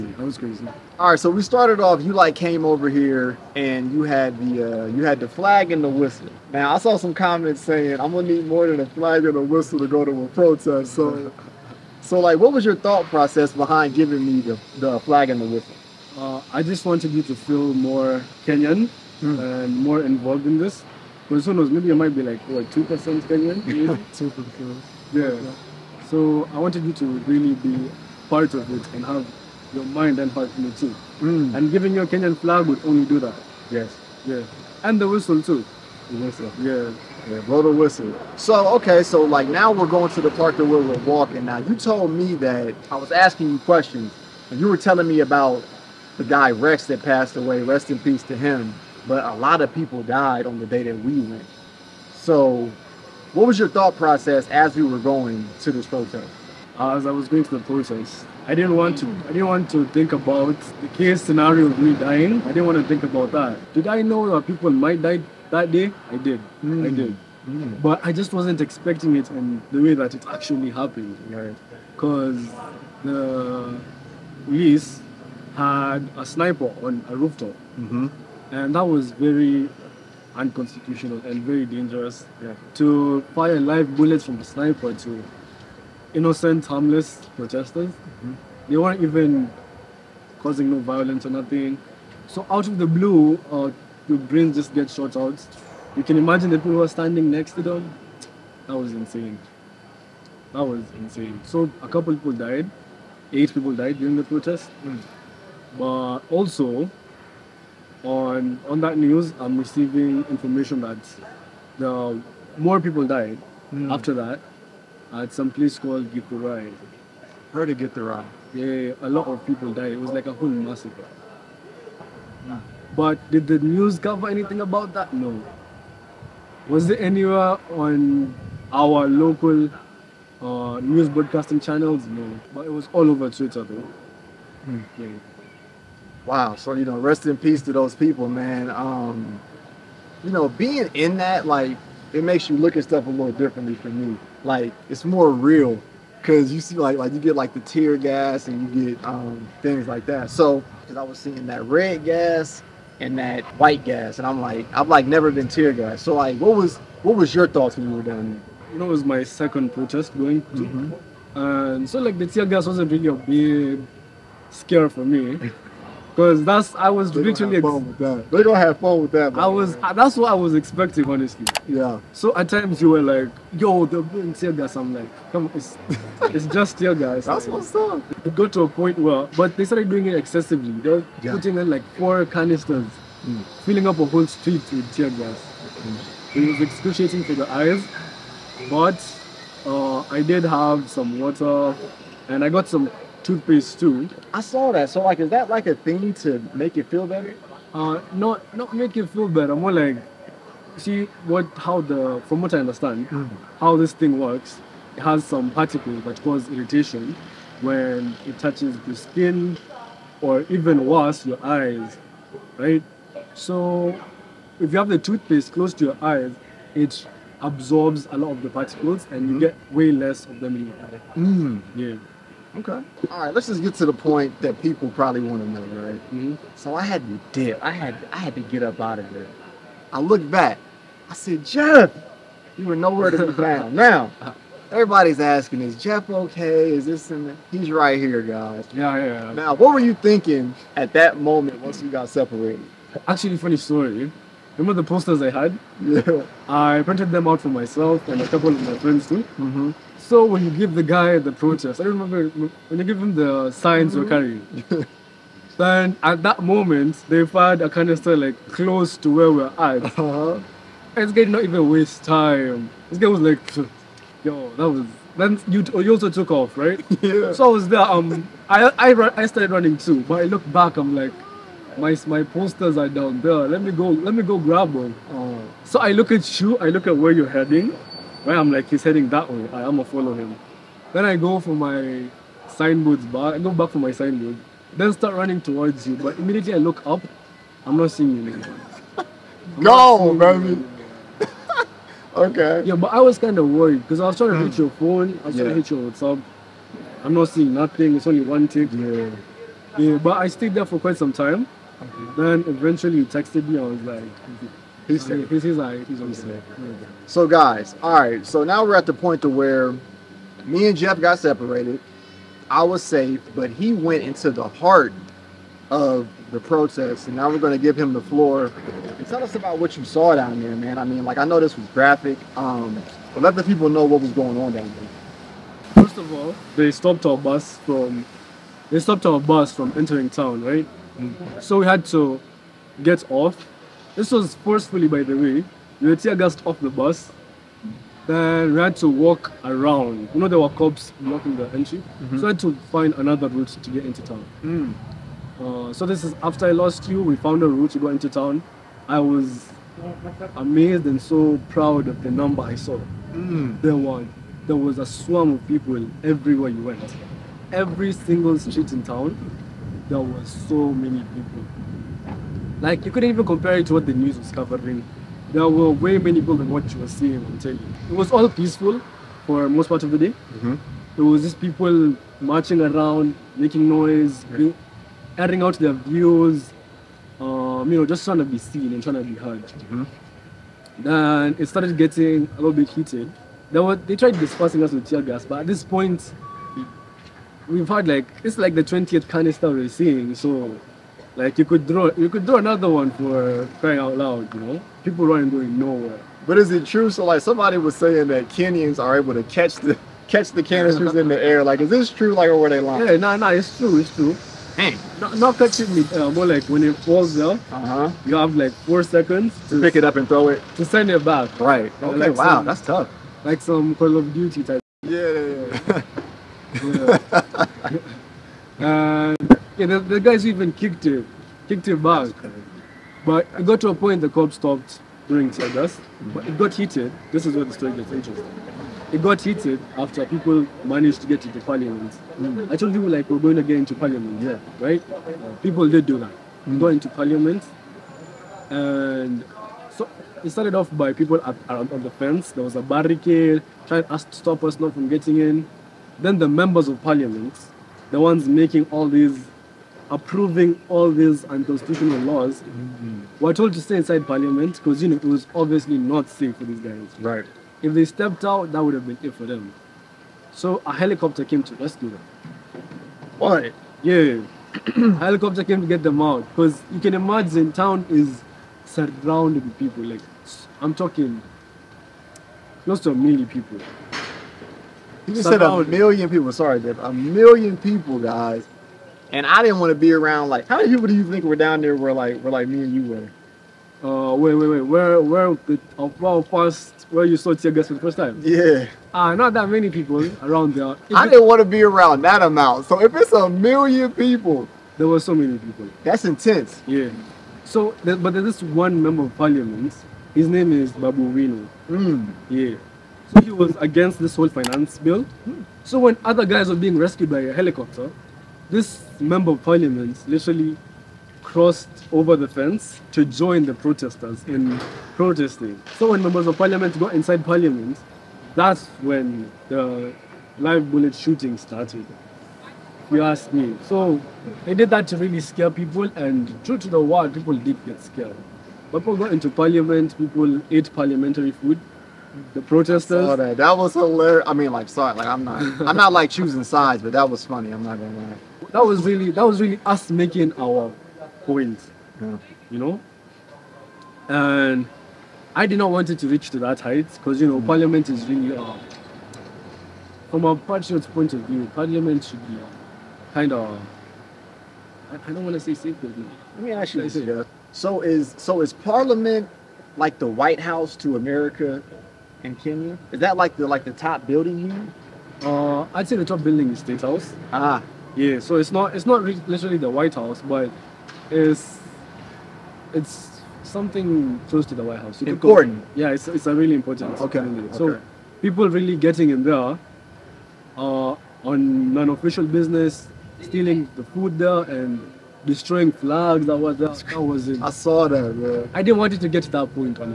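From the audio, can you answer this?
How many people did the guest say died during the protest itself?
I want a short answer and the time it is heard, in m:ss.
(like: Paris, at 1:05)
8, at 1:43.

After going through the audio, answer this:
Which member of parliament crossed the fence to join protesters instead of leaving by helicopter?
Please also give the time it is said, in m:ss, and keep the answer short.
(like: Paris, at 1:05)
Babu Owino, at 8:20.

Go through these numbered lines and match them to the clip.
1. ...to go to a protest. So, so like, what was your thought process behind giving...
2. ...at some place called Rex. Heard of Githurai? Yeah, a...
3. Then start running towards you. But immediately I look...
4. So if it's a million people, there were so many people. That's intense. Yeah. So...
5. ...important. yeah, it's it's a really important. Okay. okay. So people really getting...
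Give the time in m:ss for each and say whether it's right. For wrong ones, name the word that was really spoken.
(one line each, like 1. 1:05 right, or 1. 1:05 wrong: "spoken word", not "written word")
1. 0:09 right
2. 1:55 wrong: "Githurai", not "Rex"
3. 4:44 right
4. 8:12 right
5. 9:35 right.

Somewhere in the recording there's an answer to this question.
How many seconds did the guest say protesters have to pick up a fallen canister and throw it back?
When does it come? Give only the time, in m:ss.
6:48.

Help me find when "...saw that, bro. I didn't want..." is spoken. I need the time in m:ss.
9:47.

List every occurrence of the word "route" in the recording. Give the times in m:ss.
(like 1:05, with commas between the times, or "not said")
5:43, 5:47.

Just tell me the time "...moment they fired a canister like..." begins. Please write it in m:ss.
4:16.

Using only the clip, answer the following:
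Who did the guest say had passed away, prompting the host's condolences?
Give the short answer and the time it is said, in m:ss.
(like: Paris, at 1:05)
Rex, at 0:46.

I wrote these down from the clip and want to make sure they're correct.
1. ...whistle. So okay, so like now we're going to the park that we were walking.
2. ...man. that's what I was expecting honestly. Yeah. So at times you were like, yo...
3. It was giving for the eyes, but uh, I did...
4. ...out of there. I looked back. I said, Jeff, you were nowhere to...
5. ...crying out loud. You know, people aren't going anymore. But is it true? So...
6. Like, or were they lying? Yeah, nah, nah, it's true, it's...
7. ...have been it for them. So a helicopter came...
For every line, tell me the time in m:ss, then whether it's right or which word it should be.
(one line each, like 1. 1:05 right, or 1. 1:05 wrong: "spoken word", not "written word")
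1. 0:37 right
2. 2:49 right
3. 3:06 wrong: "excruciating", not "giving"
4. 3:48 right
5. 6:33 wrong: "nowhere", not "anymore"
6. 6:42 right
7. 7:38 right.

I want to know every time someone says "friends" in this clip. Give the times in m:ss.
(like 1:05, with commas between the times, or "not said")
4:08.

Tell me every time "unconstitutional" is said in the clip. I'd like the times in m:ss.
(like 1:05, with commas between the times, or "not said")
1:20, 7:31.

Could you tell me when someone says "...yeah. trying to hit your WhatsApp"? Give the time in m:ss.
4:55.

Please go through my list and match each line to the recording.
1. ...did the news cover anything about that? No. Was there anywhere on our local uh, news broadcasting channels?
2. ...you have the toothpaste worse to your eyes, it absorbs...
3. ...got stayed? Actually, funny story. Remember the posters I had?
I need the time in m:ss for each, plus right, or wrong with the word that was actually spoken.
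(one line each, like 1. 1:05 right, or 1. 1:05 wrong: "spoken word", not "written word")
1. 2:03 right
2. 3:34 wrong: "close", not "worse"
3. 4:01 wrong: "separated", not "stayed".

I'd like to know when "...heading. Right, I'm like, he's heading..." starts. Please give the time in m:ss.
4:37.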